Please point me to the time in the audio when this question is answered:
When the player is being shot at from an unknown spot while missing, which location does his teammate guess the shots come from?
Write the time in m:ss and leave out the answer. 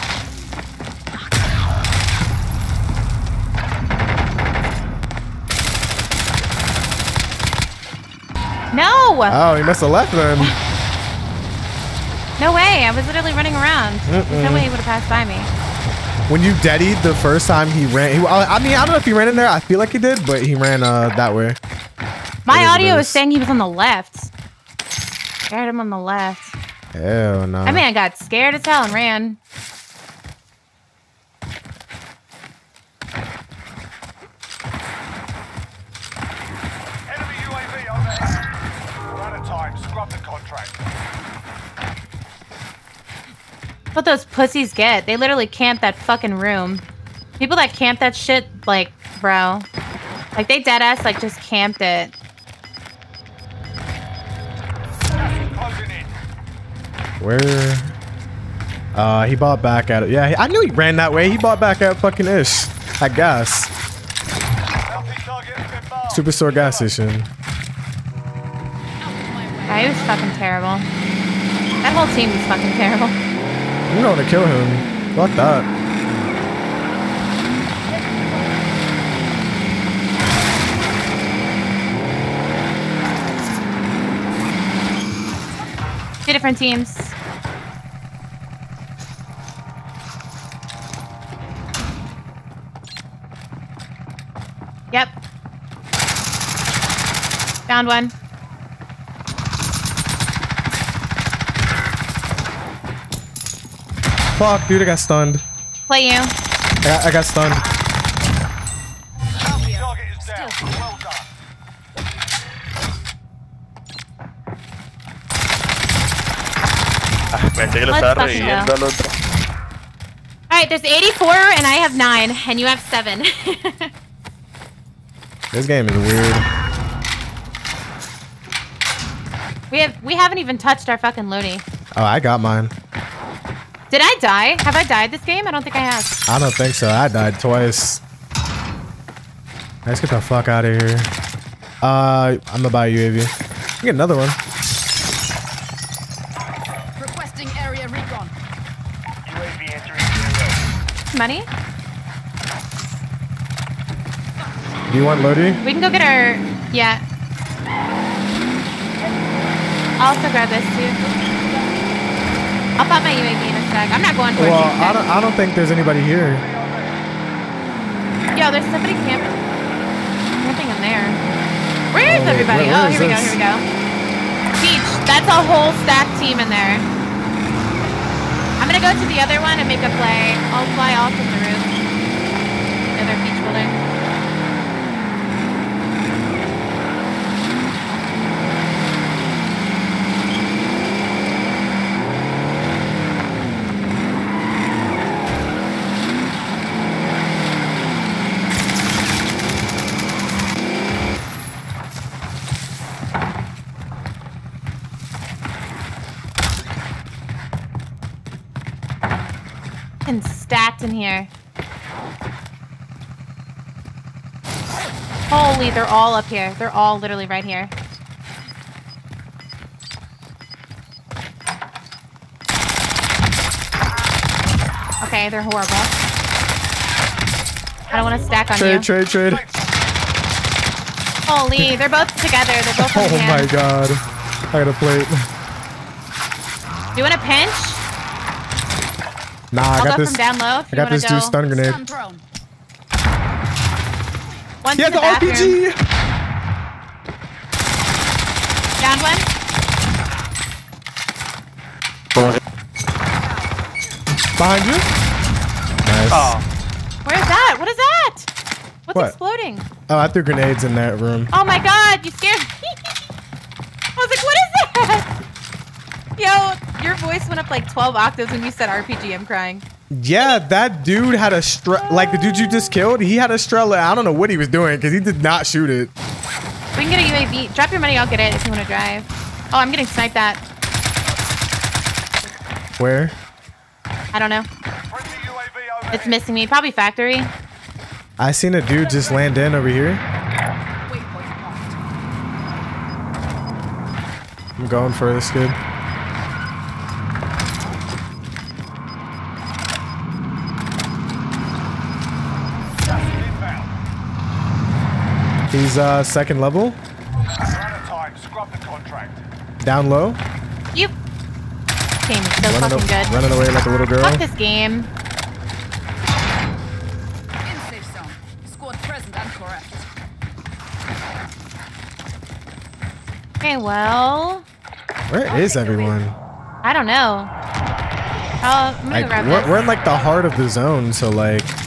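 4:46.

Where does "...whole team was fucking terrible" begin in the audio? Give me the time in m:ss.
1:11.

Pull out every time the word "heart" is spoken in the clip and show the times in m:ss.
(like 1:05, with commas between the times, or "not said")
5:29.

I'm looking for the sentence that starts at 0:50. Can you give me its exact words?
Like, they deadass, like, just camped it.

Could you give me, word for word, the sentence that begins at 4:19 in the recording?
Oh, I threw grenades in that room.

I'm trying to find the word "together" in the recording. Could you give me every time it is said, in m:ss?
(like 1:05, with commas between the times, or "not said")
3:52.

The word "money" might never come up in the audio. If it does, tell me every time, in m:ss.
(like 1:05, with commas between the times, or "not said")
2:31, 4:37.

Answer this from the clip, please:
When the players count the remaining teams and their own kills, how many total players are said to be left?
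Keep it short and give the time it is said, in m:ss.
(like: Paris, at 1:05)
84, at 2:00.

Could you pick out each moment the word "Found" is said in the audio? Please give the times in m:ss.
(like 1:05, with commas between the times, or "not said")
1:37.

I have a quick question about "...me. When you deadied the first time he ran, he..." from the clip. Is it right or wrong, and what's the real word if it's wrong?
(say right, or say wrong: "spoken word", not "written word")
right.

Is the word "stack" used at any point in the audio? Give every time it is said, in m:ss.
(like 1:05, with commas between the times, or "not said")
2:55, 3:48.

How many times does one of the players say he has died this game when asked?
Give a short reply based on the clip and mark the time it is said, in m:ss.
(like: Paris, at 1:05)
2, at 2:17.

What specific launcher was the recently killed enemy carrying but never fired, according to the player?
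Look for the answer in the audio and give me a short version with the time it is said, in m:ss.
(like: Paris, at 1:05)
Strela, at 4:33.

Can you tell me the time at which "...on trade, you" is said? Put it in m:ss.
3:48.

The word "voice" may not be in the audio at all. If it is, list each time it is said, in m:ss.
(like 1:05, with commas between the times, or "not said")
4:26.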